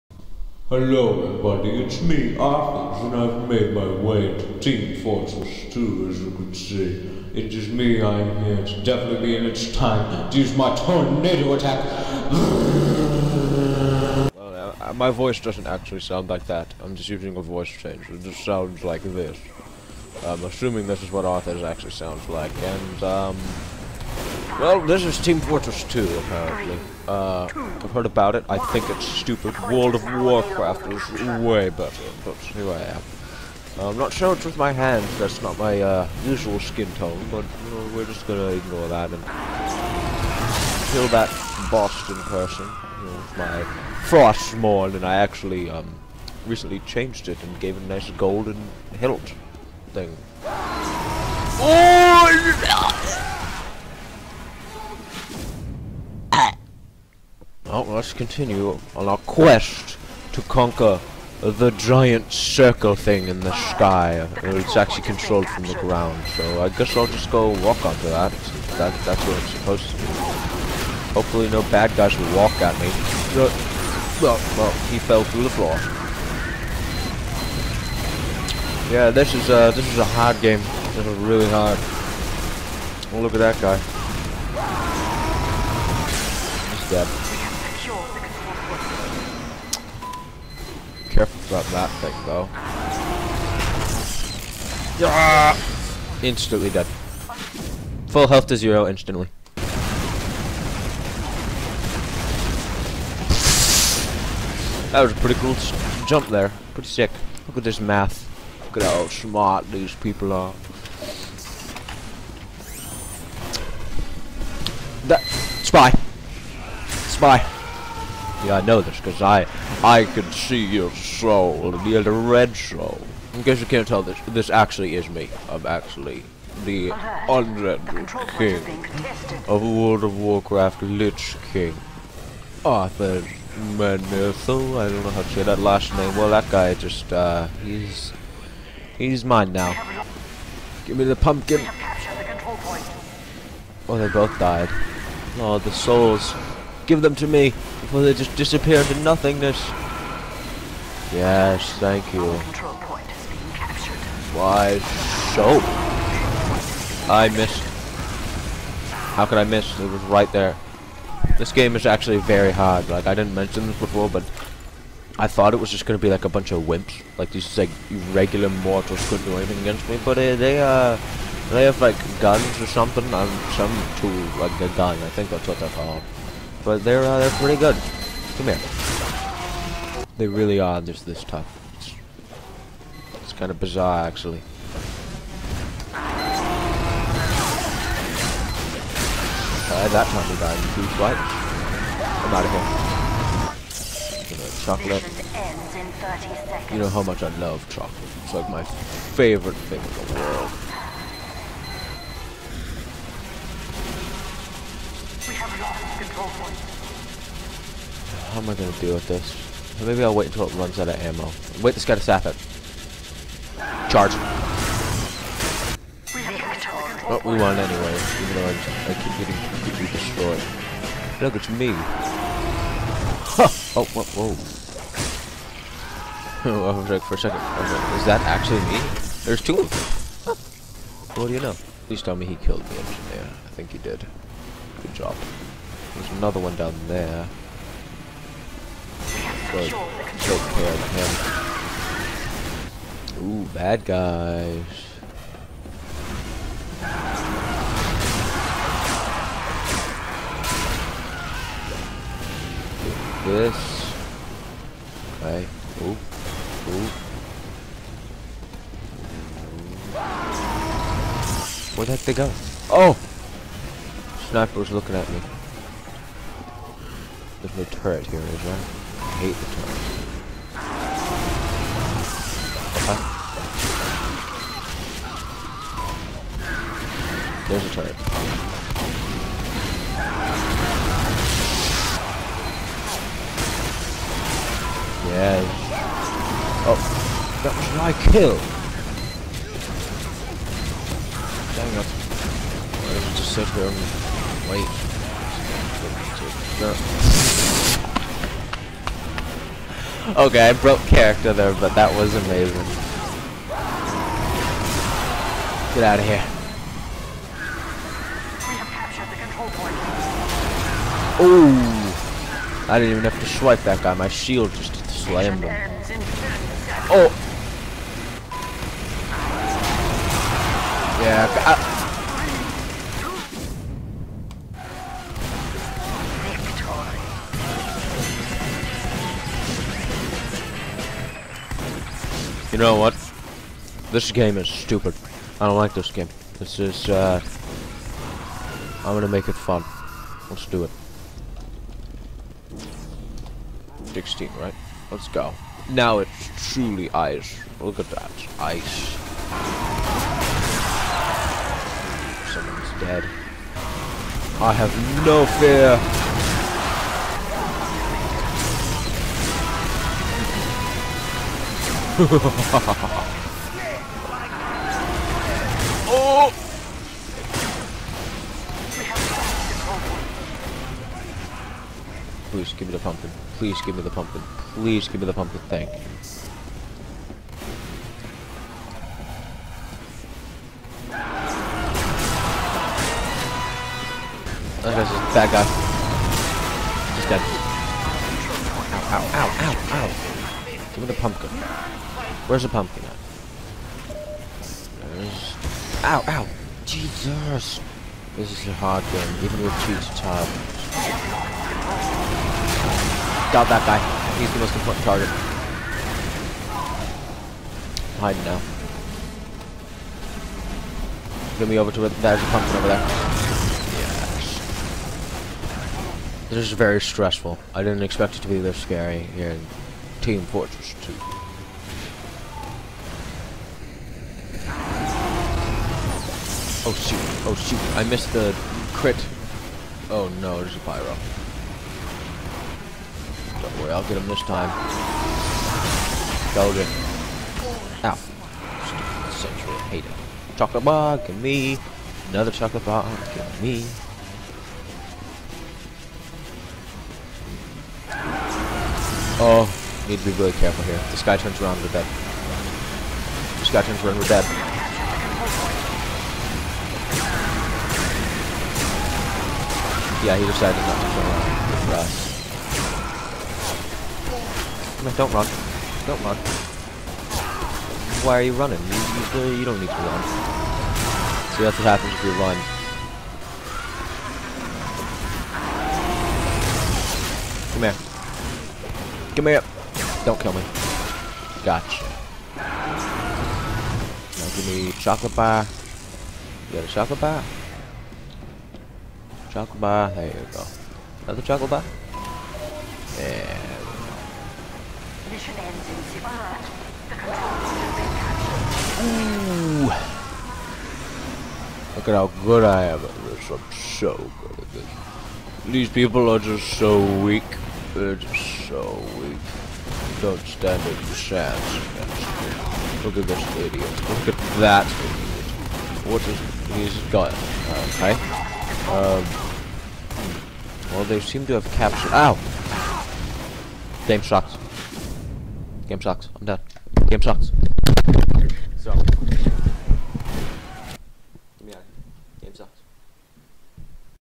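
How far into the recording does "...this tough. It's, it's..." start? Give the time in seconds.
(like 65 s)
181 s.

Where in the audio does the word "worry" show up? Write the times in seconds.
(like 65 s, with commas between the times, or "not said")
433 s.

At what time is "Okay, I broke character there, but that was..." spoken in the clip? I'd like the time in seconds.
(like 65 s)
300 s.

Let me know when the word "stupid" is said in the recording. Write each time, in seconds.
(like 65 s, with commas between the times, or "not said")
29 s, 334 s, 438 s.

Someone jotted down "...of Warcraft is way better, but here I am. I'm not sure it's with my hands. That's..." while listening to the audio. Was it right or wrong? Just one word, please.
right.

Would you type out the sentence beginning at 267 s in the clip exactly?
There's no turret here, is there?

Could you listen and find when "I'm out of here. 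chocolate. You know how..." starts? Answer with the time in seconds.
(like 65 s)
192 s.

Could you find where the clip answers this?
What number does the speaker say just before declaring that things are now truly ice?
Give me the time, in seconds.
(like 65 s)
343 s.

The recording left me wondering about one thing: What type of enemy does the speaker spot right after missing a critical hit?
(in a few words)
pyro.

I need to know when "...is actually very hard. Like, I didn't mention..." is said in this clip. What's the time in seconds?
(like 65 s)
161 s.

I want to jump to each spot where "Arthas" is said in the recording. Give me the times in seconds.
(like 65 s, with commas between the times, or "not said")
2 s, 21 s, 132 s.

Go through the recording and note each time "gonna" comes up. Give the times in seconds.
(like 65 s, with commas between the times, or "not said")
38 s, 338 s.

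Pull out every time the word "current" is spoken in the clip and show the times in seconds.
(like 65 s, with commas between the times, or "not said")
not said.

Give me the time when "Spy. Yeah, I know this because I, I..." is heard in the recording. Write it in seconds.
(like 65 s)
117 s.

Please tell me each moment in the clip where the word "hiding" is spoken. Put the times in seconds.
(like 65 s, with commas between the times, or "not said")
407 s.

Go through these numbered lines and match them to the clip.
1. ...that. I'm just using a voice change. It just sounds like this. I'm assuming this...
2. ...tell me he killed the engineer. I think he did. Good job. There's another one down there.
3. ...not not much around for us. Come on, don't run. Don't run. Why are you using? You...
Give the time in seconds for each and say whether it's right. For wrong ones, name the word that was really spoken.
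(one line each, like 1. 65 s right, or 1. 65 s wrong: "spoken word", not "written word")
1. 16 s right
2. 232 s right
3. 460 s wrong: "running", not "using".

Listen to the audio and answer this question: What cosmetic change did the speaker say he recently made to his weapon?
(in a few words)
golden hilt.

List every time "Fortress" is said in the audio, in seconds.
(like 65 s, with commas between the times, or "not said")
5 s, 25 s, 420 s.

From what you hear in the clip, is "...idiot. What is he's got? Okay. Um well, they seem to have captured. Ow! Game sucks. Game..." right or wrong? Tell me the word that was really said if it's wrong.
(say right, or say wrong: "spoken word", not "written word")
right.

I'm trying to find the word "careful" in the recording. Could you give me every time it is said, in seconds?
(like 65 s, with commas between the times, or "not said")
91 s, 450 s.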